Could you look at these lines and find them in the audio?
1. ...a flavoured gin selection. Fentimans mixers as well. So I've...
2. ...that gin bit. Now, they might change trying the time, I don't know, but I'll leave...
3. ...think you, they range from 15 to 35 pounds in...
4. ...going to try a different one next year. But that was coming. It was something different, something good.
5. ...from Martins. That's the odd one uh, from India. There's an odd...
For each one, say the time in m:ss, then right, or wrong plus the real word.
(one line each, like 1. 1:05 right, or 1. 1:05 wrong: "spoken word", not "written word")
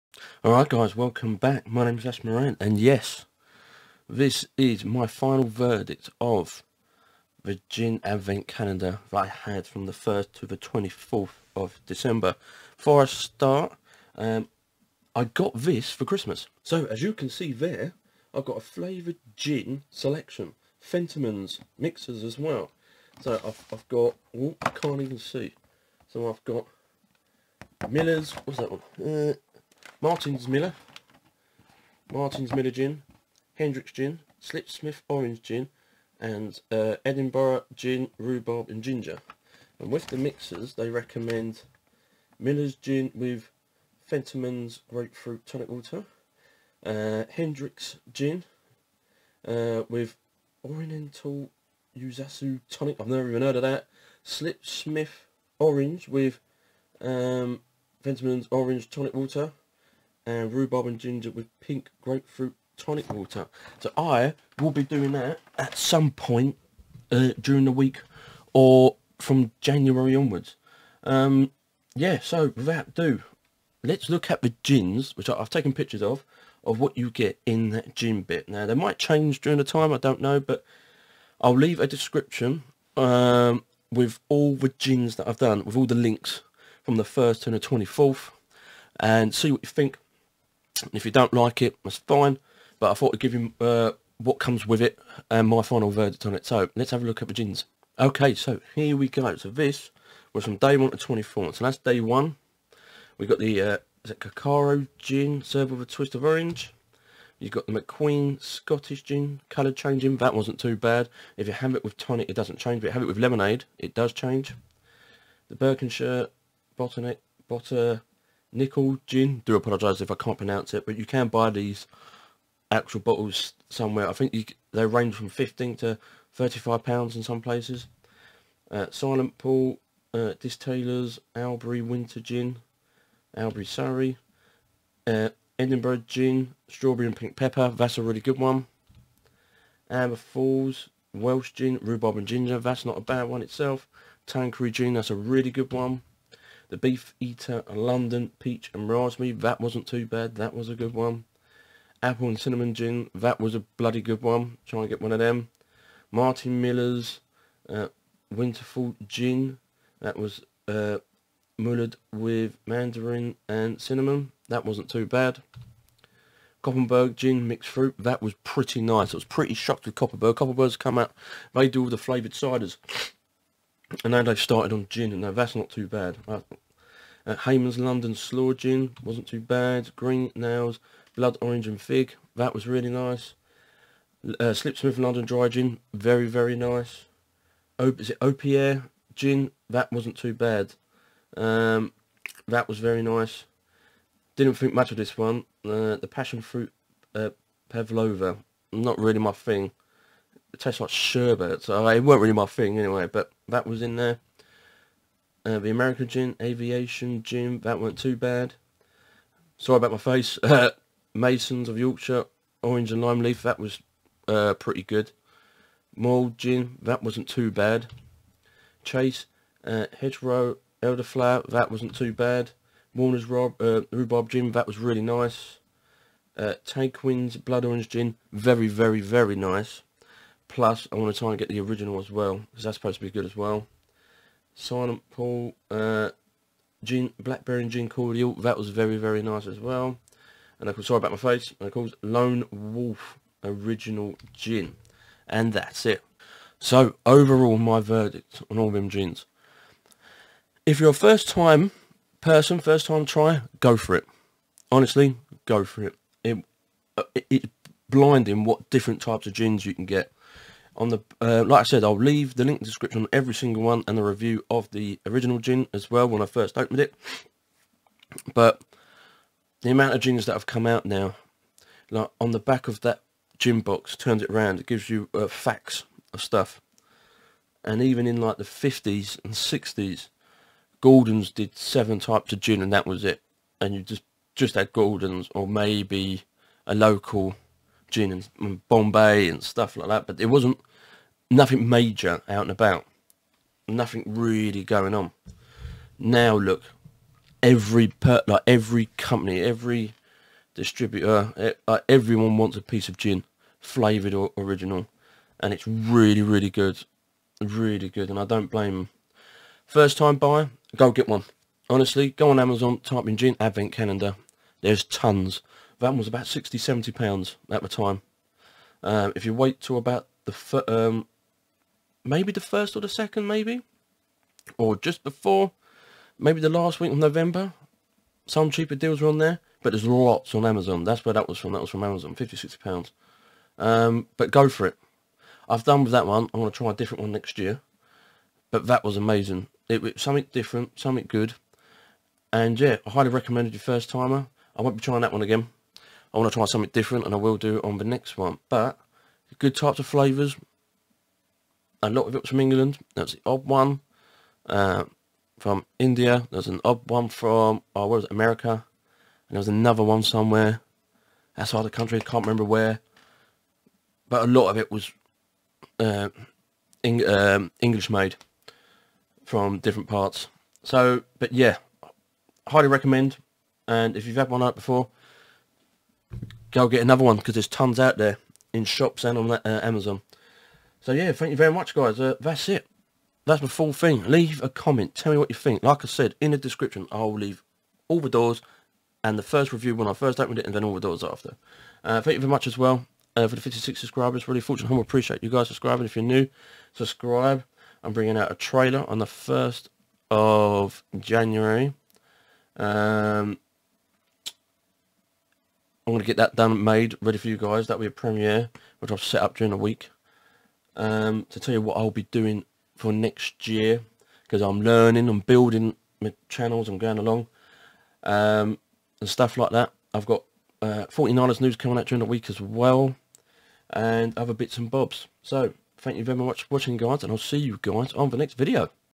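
1. 0:18 right
2. 1:17 wrong: "during", not "trying"
3. 2:04 right
4. 5:36 wrong: "amazing", not "coming"
5. 5:52 wrong: "England", not "Martins".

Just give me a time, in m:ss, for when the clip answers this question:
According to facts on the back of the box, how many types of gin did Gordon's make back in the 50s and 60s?
4:41.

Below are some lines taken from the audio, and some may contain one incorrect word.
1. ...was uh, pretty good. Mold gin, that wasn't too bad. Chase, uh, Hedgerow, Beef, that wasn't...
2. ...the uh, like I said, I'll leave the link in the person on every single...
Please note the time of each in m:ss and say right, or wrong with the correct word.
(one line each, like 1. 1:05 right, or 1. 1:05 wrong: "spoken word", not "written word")
1. 3:33 wrong: "Elderflower", not "Beef"
2. 4:20 wrong: "description", not "person".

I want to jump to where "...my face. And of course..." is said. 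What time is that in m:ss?
4:01.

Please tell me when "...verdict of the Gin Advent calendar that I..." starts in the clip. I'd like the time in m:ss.
0:05.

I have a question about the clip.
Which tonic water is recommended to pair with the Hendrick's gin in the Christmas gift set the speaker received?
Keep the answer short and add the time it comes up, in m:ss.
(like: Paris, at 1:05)
Oriental Yuzasu Tonic, at 0:50.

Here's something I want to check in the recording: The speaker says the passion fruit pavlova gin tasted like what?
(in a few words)
sherbet.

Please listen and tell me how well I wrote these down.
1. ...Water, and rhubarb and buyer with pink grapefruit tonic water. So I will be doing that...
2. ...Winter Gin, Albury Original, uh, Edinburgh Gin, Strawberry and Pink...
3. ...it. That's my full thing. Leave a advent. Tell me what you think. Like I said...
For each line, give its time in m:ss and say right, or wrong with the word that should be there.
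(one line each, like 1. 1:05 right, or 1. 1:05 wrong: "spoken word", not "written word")
1. 0:59 wrong: "ginger", not "buyer"
2. 2:11 wrong: "Surrey", not "Original"
3. 6:22 wrong: "comment", not "advent".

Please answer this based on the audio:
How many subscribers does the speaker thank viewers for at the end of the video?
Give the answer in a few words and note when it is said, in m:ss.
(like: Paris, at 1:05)
56, at 6:33.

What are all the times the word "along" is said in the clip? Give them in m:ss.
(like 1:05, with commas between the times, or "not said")
6:56.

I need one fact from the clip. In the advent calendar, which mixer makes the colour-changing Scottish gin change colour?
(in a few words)
lemonade.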